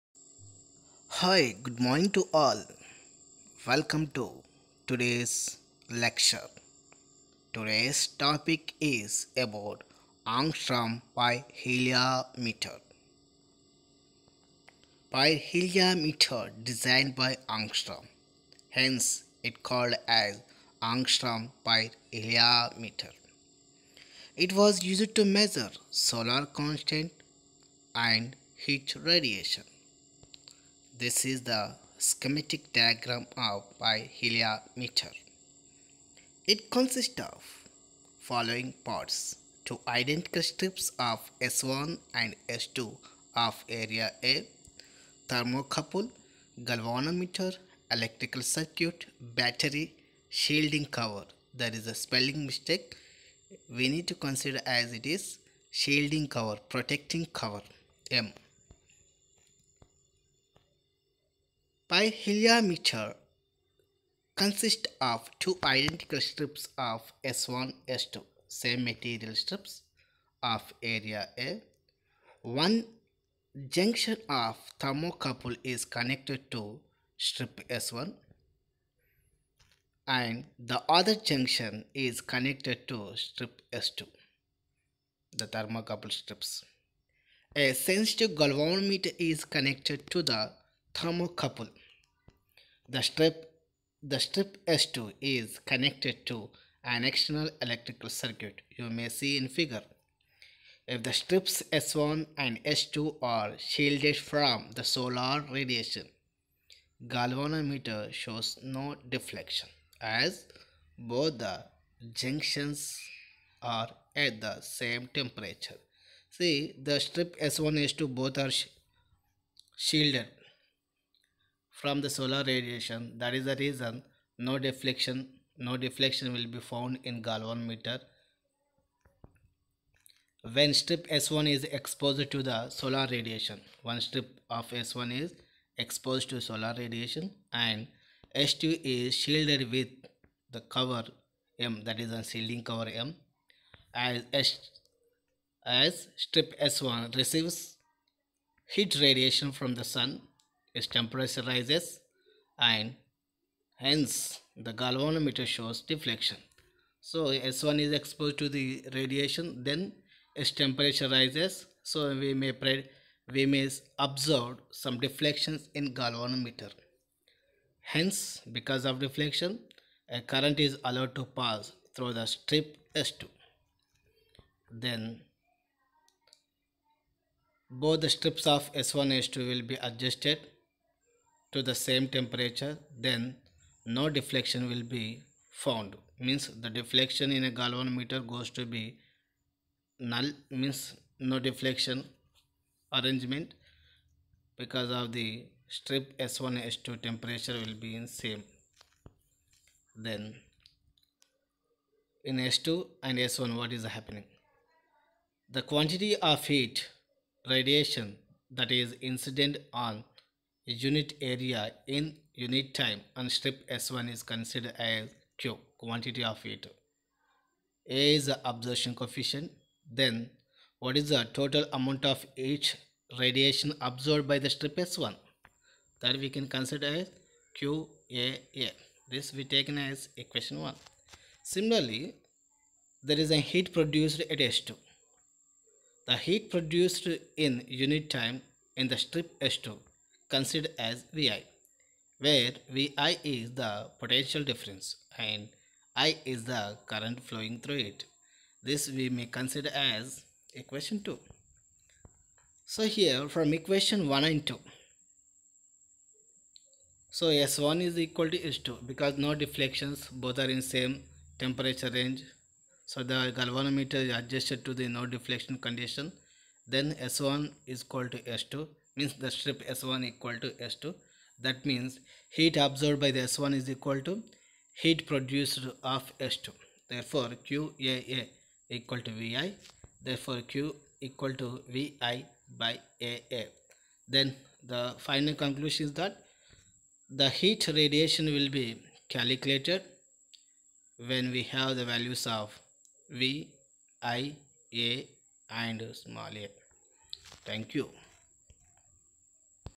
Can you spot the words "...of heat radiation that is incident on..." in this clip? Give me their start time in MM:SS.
03:26.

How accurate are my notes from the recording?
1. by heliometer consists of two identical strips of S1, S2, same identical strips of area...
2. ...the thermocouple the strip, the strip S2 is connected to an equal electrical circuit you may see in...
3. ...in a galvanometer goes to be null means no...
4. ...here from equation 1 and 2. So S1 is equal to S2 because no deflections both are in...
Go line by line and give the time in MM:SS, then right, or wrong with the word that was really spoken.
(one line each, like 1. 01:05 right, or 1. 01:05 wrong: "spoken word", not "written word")
1. 01:01 wrong: "material", not "identical"
2. 01:30 wrong: "external", not "equal"
3. 03:07 right
4. 04:12 right.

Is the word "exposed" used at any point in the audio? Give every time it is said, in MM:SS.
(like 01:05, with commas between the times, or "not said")
02:11, 02:15, 02:37.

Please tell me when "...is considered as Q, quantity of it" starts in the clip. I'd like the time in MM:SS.
03:34.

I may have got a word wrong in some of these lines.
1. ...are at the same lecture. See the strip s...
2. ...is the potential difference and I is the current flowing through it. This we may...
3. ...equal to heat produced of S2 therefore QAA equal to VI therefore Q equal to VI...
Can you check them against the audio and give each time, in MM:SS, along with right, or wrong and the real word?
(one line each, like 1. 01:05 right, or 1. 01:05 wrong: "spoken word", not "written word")
1. 01:53 wrong: "temperature", not "lecture"
2. 04:03 right
3. 04:33 right.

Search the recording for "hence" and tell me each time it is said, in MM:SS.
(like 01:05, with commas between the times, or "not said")
00:18, 02:33, 02:47.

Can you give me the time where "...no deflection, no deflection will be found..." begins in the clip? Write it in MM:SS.
02:04.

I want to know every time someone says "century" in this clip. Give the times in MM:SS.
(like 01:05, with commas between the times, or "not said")
not said.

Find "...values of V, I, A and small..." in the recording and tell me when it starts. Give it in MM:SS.
04:51.